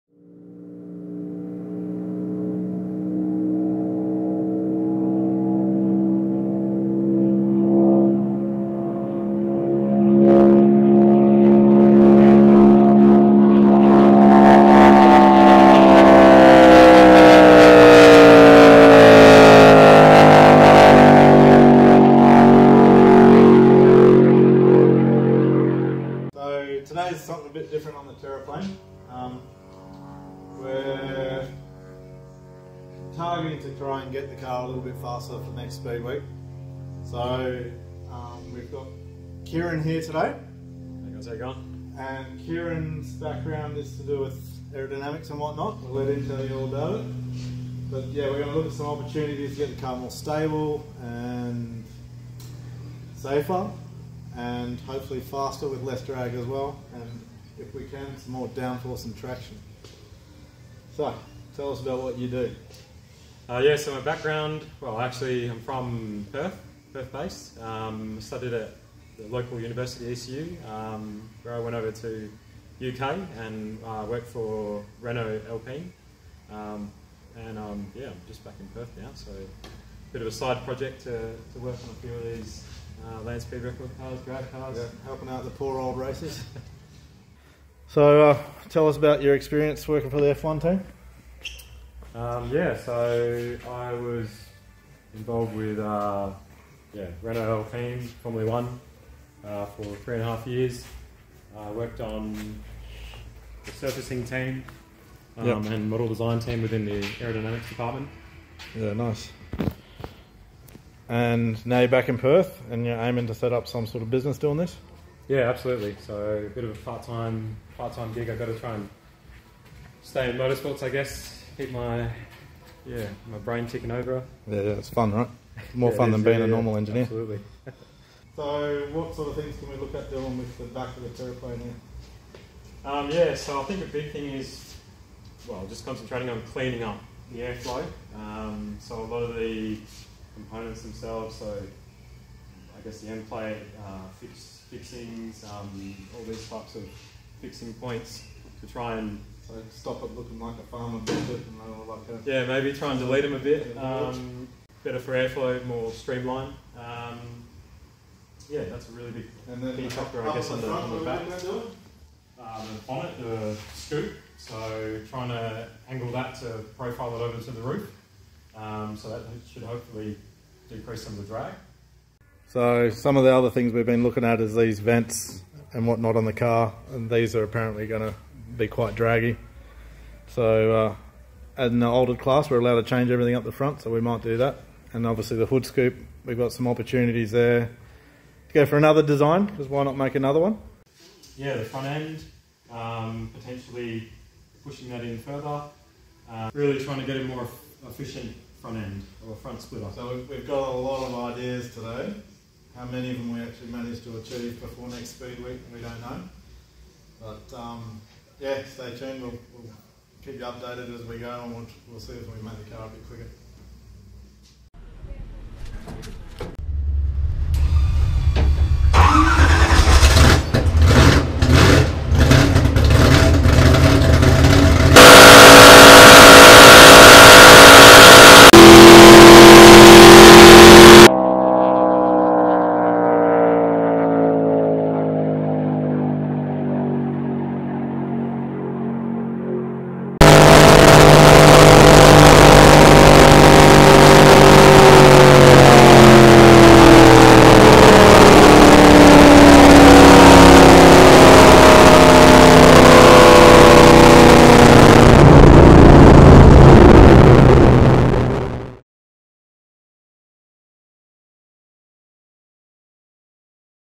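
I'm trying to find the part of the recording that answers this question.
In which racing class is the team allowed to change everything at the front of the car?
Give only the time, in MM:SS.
03:01.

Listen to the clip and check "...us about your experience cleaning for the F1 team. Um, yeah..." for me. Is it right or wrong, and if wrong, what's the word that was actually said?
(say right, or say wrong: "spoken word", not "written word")
wrong: "working", not "cleaning".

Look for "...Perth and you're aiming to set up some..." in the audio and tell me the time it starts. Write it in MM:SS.
01:52.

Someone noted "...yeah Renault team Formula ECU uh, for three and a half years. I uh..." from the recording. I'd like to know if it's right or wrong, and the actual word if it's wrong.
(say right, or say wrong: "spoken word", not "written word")
wrong: "One", not "ECU".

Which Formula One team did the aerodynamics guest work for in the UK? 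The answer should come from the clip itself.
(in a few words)
Renault Alpine.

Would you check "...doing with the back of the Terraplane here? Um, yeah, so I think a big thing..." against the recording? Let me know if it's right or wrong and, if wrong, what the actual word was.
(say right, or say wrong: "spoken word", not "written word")
right.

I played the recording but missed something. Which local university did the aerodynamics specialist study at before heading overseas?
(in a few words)
ECU.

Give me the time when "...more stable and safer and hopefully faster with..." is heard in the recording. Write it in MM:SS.
00:49.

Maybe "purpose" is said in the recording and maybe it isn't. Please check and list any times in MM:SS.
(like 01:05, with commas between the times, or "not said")
not said.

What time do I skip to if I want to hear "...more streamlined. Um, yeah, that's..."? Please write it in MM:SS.
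02:35.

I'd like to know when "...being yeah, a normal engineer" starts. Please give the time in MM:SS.
02:06.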